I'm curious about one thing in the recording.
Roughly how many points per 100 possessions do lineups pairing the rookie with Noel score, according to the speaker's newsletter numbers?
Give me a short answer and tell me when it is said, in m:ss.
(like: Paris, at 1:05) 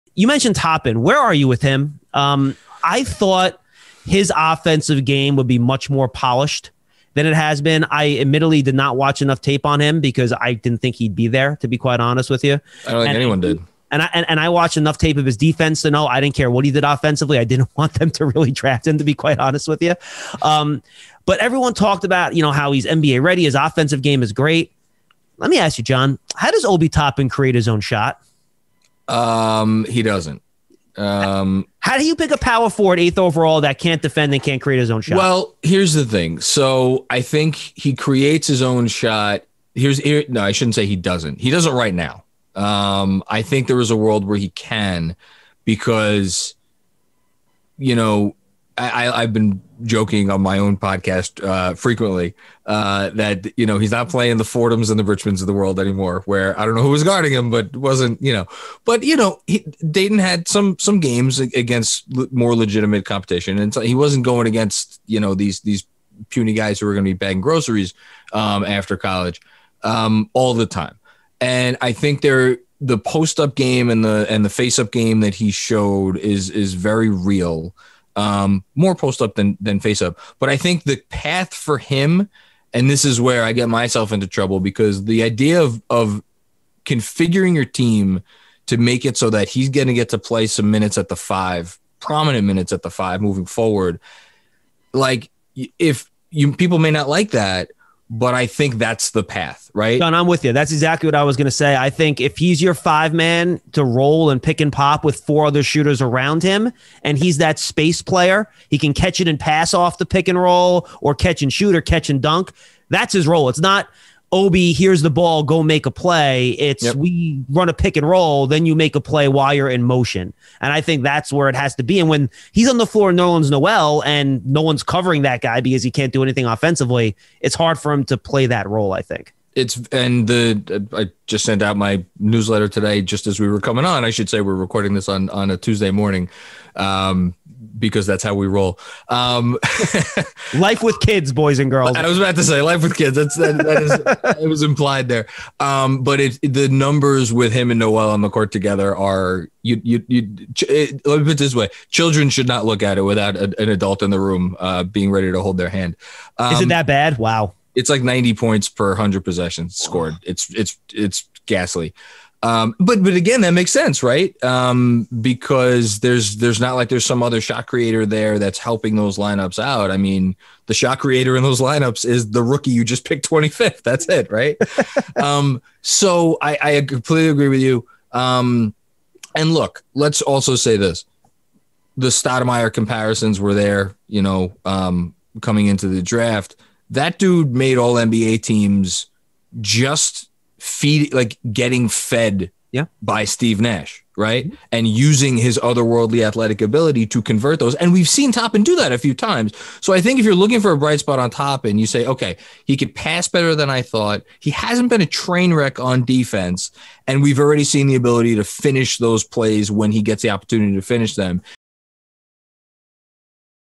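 90, at 2:38.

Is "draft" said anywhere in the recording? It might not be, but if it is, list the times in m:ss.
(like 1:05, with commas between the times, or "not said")
0:18, 3:06.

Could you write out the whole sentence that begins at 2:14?
I should say we're recording this on on a Tuesday morning.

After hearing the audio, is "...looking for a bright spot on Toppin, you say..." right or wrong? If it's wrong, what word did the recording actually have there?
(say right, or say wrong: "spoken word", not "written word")
right.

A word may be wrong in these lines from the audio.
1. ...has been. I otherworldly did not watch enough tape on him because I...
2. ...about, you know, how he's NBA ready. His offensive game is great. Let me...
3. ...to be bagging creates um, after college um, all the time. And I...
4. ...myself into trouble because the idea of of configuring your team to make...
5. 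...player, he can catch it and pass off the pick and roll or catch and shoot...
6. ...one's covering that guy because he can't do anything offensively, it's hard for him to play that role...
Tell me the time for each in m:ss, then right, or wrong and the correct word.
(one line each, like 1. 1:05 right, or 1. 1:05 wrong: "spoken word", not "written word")
1. 0:07 wrong: "admittedly", not "otherworldly"
2. 0:22 right
3. 1:07 wrong: "groceries", not "creates"
4. 1:23 right
5. 1:48 right
6. 2:04 right.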